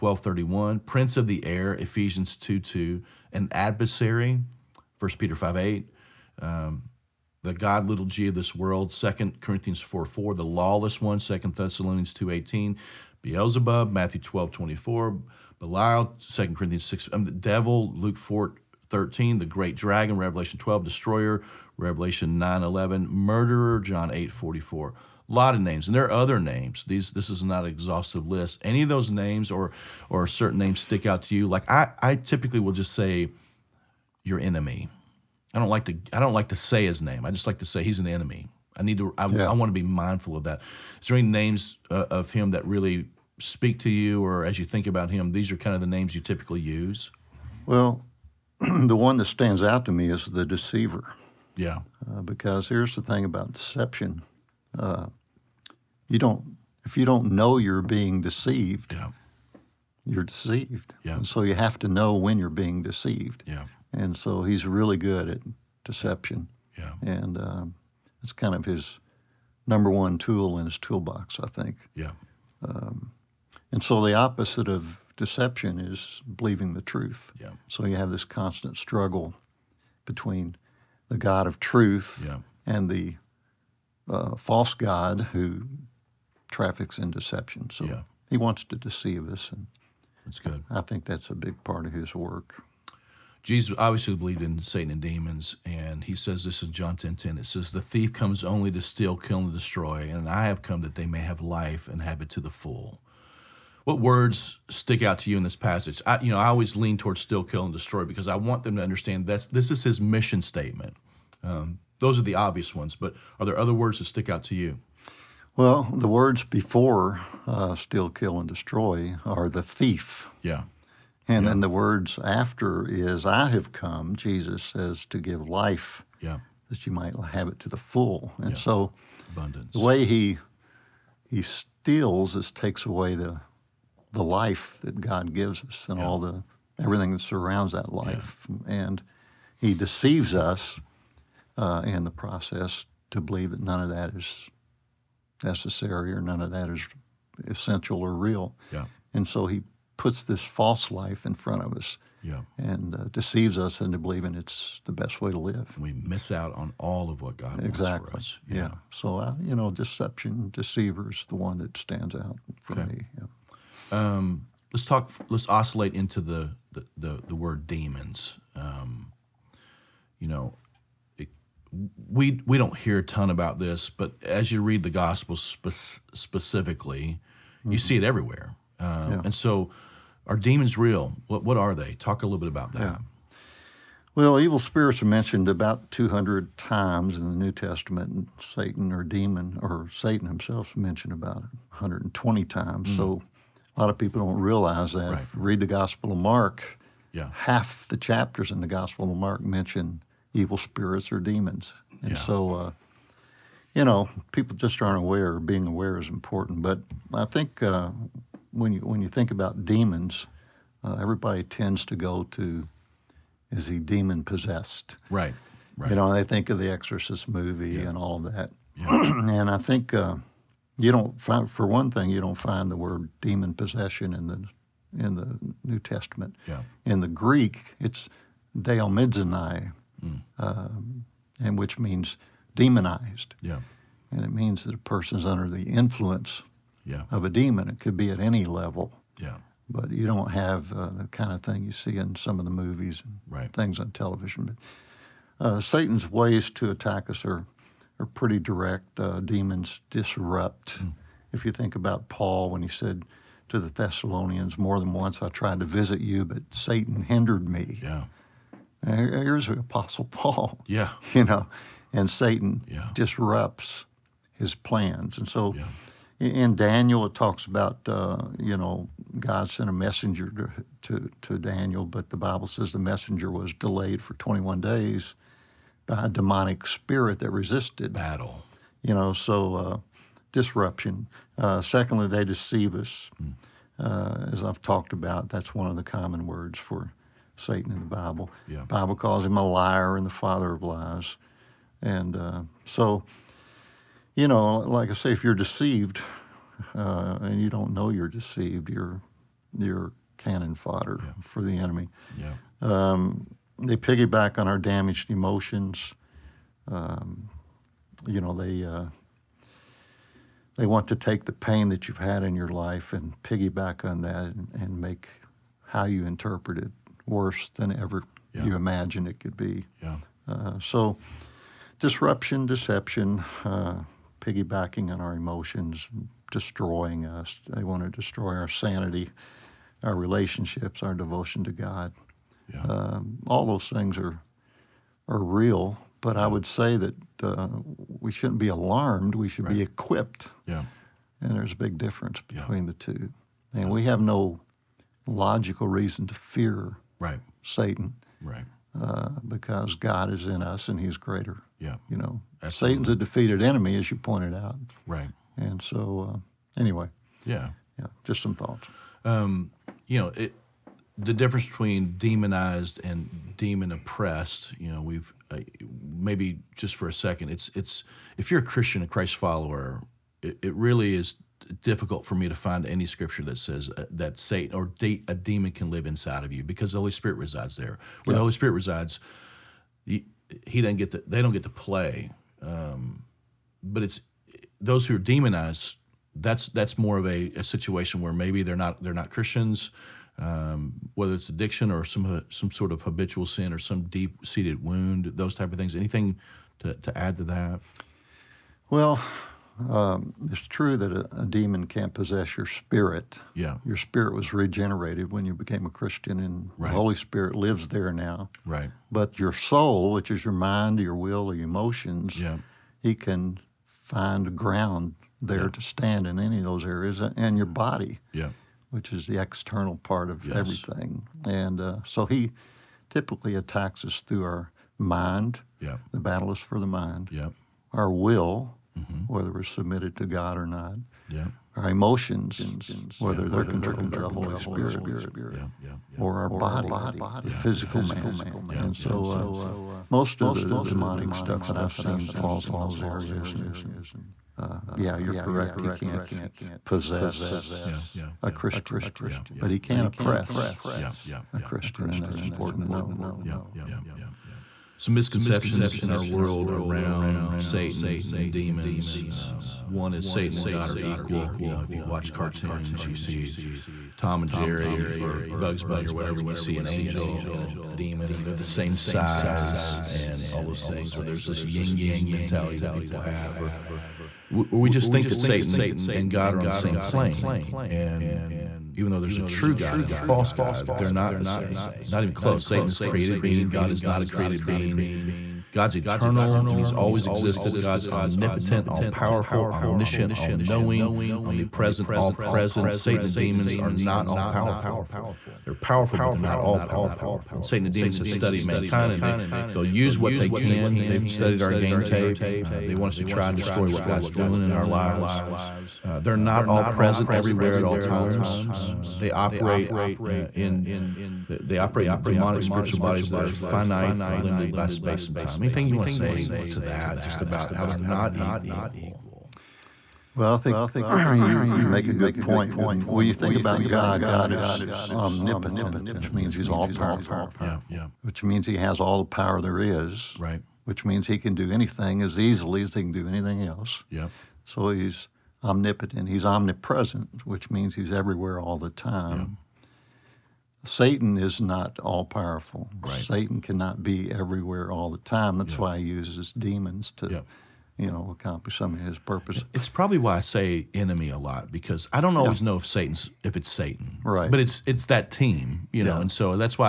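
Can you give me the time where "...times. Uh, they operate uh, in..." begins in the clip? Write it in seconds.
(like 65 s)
507 s.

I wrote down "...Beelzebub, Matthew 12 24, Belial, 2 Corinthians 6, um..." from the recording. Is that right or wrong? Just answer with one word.
right.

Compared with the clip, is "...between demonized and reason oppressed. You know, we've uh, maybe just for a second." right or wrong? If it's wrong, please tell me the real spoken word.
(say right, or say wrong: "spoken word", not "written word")
wrong: "demon", not "reason".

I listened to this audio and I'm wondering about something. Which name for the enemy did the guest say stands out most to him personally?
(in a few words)
the deceiver.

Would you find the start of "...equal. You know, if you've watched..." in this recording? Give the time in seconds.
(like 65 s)
460 s.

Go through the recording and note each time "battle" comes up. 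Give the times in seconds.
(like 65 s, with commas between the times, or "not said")
277 s, 426 s.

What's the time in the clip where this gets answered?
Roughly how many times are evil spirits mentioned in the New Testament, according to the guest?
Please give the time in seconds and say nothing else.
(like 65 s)
185 s.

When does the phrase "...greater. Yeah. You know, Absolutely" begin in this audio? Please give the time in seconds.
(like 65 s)
350 s.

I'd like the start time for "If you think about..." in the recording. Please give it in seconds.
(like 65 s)
251 s.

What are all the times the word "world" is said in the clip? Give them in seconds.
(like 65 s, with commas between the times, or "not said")
8 s, 456 s.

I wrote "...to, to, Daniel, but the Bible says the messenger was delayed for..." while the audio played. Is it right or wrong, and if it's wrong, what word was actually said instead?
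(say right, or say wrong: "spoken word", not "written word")
right.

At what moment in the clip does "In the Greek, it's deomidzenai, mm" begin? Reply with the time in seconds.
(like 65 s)
226 s.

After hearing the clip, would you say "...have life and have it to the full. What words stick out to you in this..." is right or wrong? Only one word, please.
right.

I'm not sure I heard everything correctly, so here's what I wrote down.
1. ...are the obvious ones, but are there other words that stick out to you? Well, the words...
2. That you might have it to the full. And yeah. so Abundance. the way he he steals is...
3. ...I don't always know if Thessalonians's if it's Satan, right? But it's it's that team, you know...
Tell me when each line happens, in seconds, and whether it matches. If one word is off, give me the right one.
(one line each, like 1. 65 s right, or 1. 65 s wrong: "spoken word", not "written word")
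1. 112 s right
2. 126 s right
3. 551 s wrong: "Satan", not "Thessalonians".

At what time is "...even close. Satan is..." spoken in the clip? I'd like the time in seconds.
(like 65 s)
482 s.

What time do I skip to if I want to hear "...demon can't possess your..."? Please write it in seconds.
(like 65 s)
401 s.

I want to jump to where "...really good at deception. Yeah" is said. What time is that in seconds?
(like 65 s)
64 s.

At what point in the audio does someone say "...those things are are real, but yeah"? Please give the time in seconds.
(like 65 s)
333 s.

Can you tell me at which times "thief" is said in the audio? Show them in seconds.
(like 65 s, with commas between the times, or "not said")
97 s, 119 s.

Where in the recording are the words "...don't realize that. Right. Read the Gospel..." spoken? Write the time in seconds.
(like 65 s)
194 s.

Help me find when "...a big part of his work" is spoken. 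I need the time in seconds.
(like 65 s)
91 s.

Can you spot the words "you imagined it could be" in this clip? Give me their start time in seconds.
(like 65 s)
318 s.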